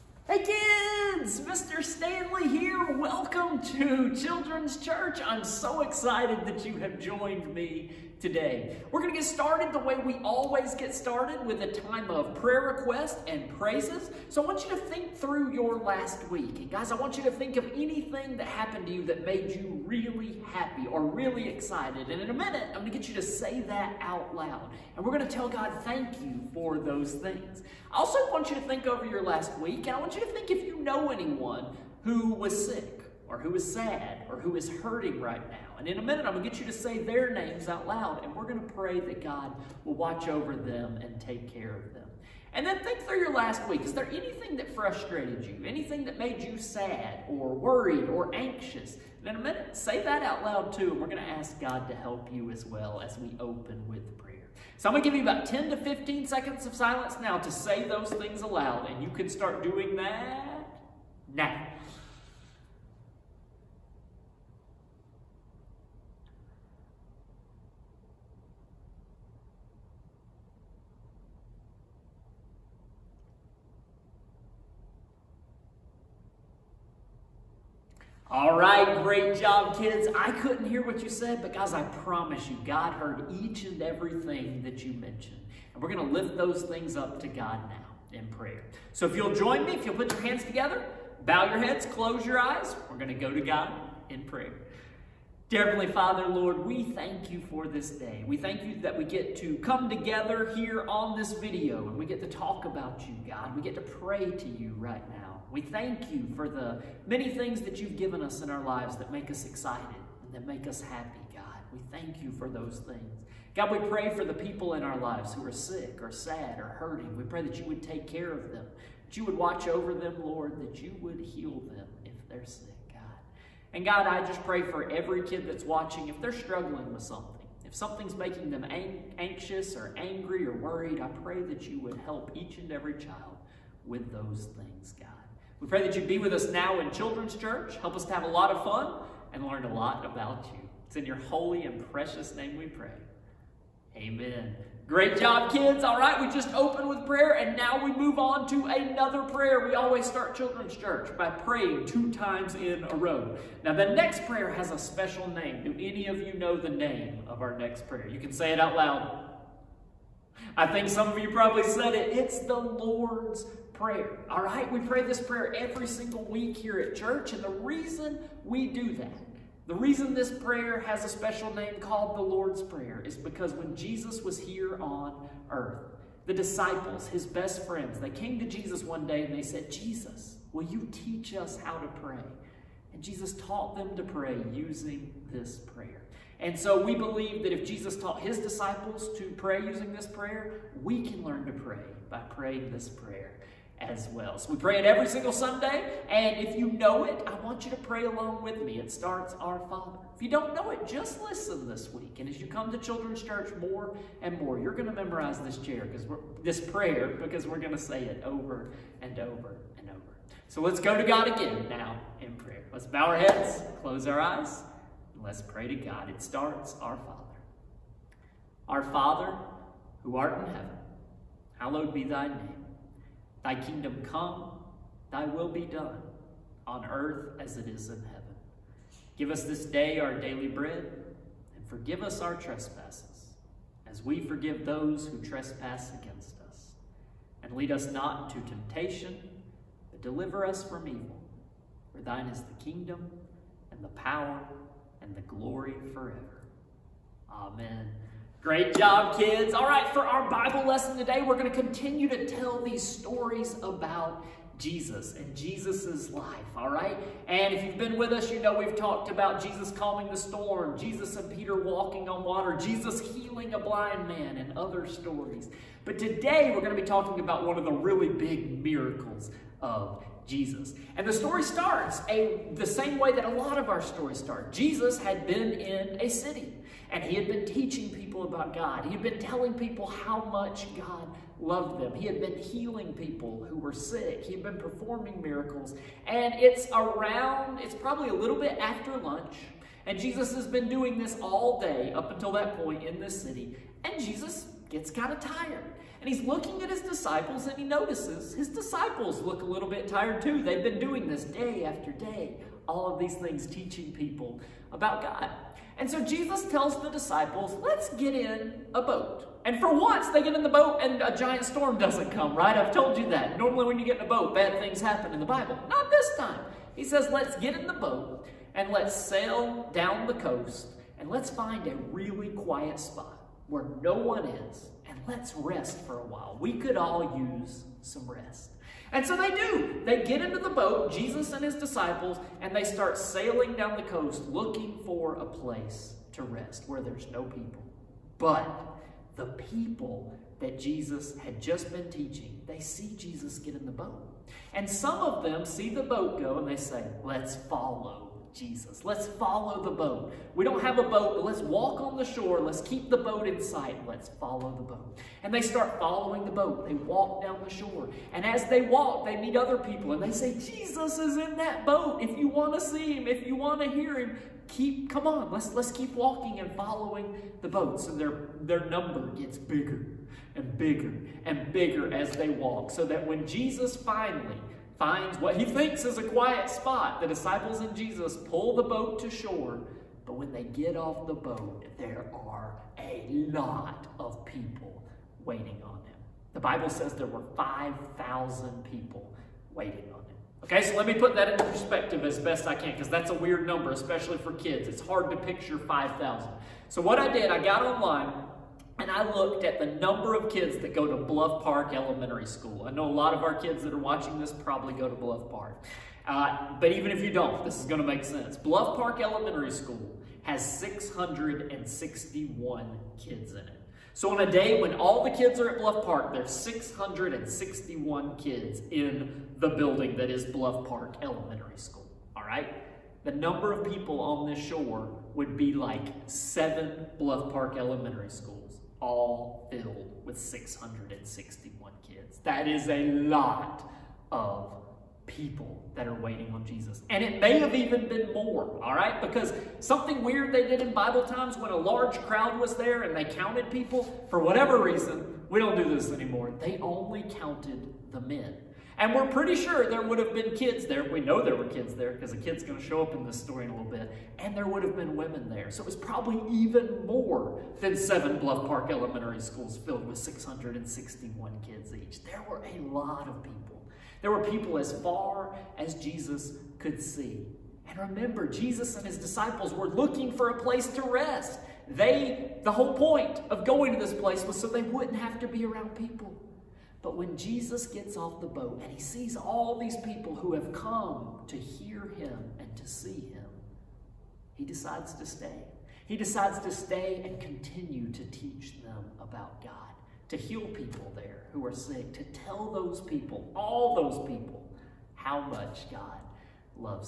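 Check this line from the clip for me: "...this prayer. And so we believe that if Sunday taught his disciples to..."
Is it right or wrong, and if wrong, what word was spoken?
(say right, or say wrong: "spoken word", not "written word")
wrong: "Jesus", not "Sunday".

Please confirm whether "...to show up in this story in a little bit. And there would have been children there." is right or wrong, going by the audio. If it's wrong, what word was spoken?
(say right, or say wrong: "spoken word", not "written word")
wrong: "women", not "children".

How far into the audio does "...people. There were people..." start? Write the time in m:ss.
7:43.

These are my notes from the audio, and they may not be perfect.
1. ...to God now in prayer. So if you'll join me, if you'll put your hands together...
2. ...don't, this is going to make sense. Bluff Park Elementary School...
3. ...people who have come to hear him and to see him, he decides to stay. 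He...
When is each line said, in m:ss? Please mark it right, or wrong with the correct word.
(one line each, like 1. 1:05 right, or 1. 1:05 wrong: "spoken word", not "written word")
1. 1:27 right
2. 6:47 right
3. 7:59 right.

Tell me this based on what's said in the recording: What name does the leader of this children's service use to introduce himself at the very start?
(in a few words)
Mr. Stanley.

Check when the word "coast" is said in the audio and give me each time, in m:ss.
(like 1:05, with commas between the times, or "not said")
5:20, 5:33.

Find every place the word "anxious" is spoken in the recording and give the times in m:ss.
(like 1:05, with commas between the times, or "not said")
0:48, 2:09.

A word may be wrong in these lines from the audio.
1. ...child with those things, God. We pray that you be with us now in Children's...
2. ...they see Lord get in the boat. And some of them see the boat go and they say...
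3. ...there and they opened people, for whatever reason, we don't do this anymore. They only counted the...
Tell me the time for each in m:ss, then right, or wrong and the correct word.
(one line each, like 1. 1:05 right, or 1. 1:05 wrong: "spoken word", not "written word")
1. 2:12 right
2. 5:42 wrong: "Jesus", not "Lord"
3. 7:22 wrong: "counted", not "opened".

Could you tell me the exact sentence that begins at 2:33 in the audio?
Now, the next prayer has a special name.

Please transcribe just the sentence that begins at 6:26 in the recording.
The Bible says there were 5,000 people waiting on them.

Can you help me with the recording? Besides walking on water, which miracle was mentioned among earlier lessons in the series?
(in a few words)
healing a blind man.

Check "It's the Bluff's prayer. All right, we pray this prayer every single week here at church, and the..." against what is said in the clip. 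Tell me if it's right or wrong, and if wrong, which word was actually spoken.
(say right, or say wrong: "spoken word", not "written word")
wrong: "Lord", not "Bluff".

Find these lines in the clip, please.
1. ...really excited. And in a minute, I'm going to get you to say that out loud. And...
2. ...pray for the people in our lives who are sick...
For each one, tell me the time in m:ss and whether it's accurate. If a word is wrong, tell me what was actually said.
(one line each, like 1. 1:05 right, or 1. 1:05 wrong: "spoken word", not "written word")
1. 0:21 right
2. 1:53 right.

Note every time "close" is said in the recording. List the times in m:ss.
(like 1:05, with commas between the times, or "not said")
1:31, 3:33.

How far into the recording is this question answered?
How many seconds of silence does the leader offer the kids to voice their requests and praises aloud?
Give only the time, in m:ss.
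0:55.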